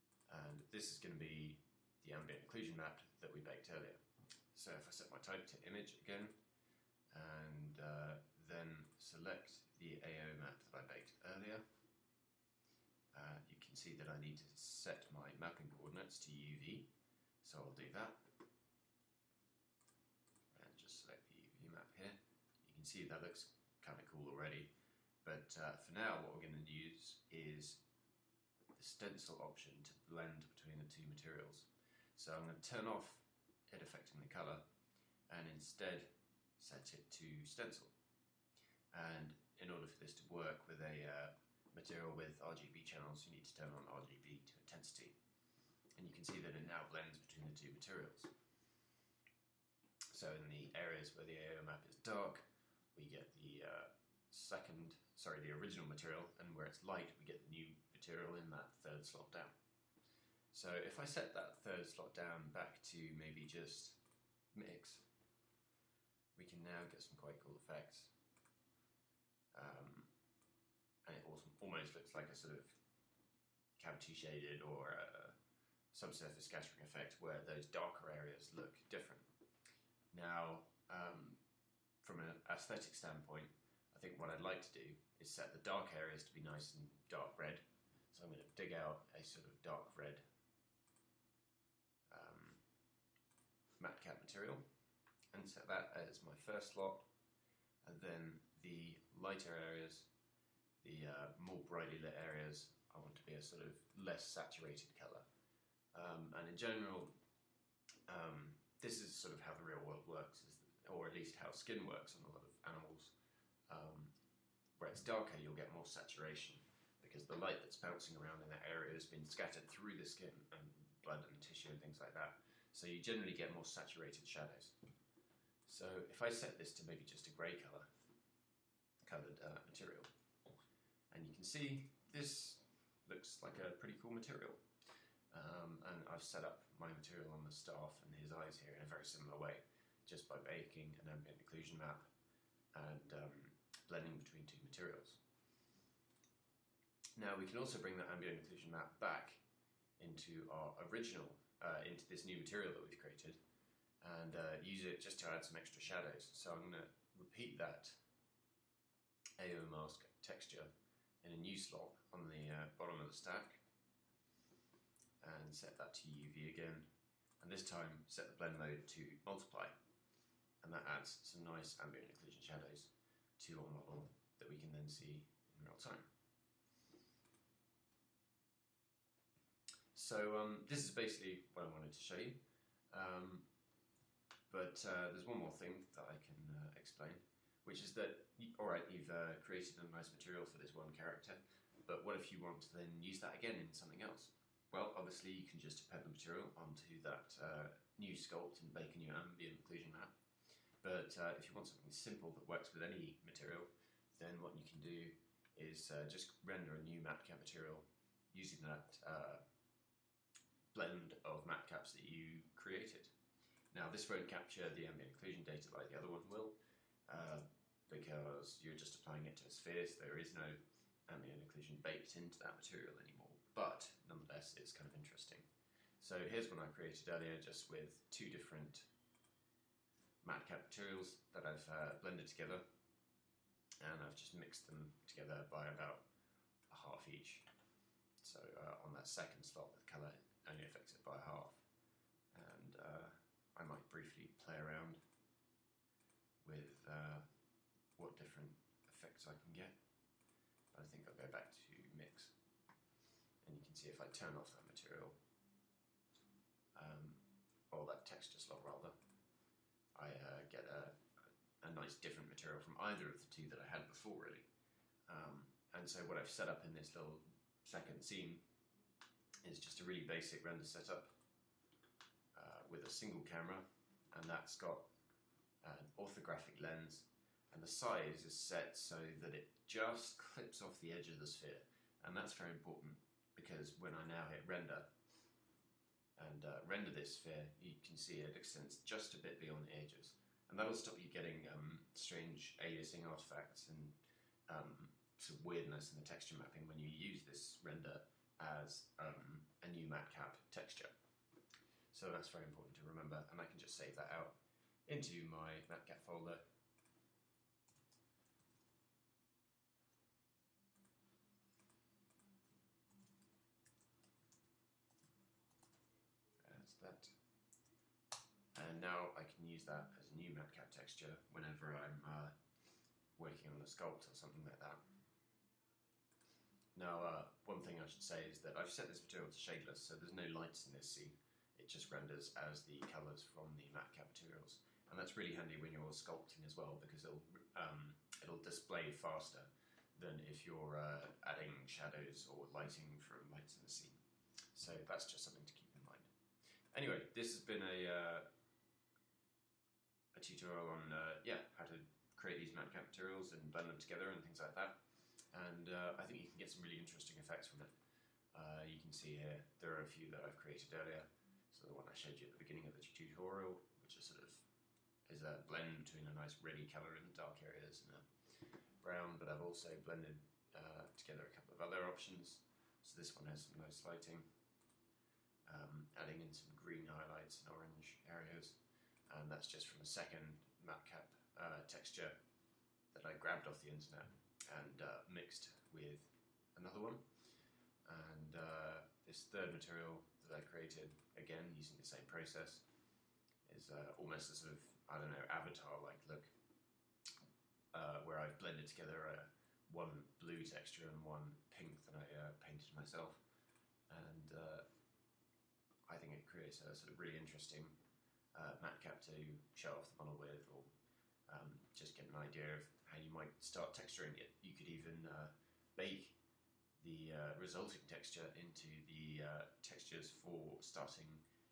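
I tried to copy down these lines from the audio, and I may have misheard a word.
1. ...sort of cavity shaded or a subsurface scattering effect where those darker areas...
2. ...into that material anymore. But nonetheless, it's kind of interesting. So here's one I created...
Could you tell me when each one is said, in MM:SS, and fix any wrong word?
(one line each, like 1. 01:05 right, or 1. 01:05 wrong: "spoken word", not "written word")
1. 01:12 right
2. 03:42 right.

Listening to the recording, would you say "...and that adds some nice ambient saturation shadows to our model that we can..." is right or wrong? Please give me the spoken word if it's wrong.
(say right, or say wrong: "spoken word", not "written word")
wrong: "occlusion", not "saturation".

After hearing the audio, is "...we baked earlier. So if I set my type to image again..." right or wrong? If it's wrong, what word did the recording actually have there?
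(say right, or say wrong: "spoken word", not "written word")
right.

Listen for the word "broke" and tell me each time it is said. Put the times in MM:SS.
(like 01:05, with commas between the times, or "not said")
not said.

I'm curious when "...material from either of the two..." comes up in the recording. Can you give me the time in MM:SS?
04:22.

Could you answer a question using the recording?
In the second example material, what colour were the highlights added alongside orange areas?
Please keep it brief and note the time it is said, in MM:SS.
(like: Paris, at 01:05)
Green, at 06:16.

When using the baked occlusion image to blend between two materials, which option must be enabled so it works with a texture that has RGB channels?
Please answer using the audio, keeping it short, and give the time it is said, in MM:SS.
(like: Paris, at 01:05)
RGB to intensity, at 00:43.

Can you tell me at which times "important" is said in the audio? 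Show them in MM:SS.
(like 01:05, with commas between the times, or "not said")
04:42, 05:02.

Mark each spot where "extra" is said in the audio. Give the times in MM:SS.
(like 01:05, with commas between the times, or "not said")
02:35.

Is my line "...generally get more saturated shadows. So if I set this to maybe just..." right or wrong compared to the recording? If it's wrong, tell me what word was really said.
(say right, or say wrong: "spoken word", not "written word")
right.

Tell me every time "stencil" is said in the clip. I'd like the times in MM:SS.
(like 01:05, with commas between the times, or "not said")
00:28, 00:37.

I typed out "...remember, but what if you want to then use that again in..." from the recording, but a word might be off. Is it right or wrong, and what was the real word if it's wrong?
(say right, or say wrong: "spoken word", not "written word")
wrong: "character", not "remember".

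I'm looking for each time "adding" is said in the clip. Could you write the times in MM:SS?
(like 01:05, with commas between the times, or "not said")
05:41, 06:15.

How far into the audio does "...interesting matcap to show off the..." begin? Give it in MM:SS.
06:47.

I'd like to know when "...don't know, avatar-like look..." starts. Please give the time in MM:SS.
06:34.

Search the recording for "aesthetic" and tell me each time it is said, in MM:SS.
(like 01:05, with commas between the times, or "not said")
01:22.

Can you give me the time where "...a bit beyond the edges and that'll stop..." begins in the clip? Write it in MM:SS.
04:49.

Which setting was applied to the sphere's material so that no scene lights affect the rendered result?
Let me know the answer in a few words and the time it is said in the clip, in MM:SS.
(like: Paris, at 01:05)
Shadeless, at 05:29.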